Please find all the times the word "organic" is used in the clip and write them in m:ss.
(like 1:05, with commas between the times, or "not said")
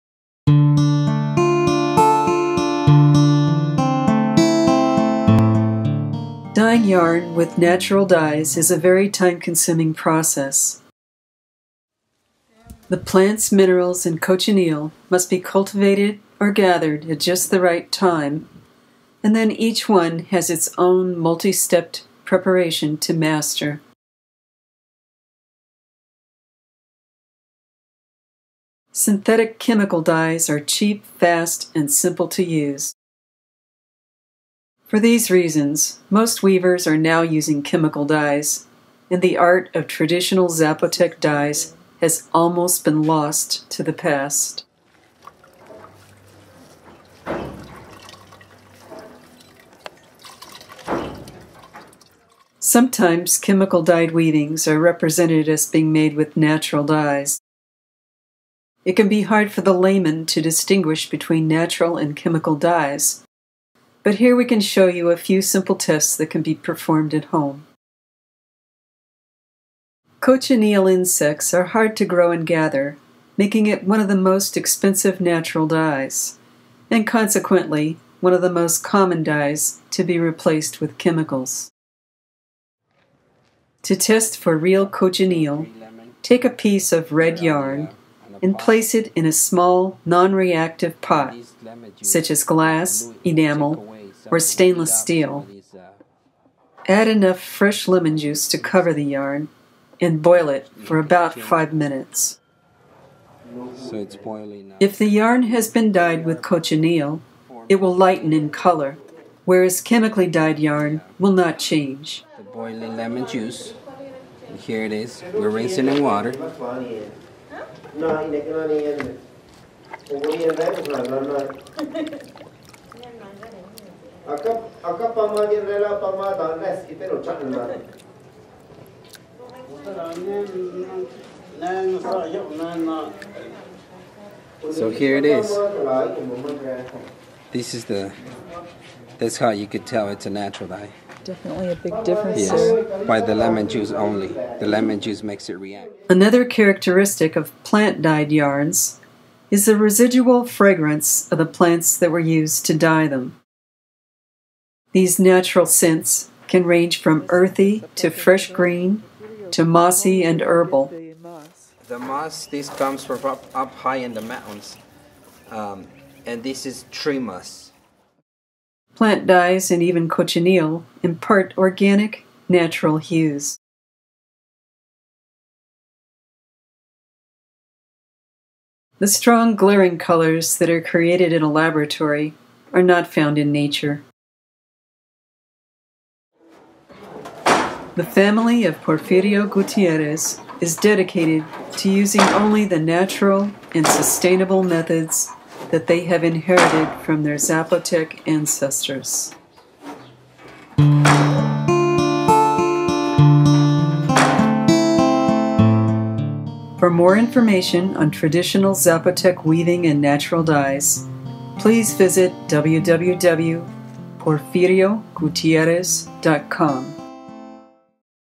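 2:51.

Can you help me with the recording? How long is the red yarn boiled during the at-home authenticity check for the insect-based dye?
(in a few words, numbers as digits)
about 5 minutes.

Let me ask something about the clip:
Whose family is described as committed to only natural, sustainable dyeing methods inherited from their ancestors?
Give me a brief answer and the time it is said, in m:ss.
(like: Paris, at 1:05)
Porfirio Gutierrez, at 3:08.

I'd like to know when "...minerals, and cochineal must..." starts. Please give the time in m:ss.
0:13.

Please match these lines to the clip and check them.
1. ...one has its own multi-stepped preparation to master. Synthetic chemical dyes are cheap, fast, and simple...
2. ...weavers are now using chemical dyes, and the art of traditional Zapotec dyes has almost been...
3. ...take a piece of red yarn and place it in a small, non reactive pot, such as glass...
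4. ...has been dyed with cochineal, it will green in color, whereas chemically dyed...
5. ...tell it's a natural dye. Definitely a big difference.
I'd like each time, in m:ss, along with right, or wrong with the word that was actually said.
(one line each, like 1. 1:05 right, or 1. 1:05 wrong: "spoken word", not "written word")
1. 0:19 right
2. 0:36 right
3. 1:26 right
4. 1:45 wrong: "lighten", not "green"
5. 2:19 right.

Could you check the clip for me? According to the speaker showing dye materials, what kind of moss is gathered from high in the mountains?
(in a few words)
tree moss.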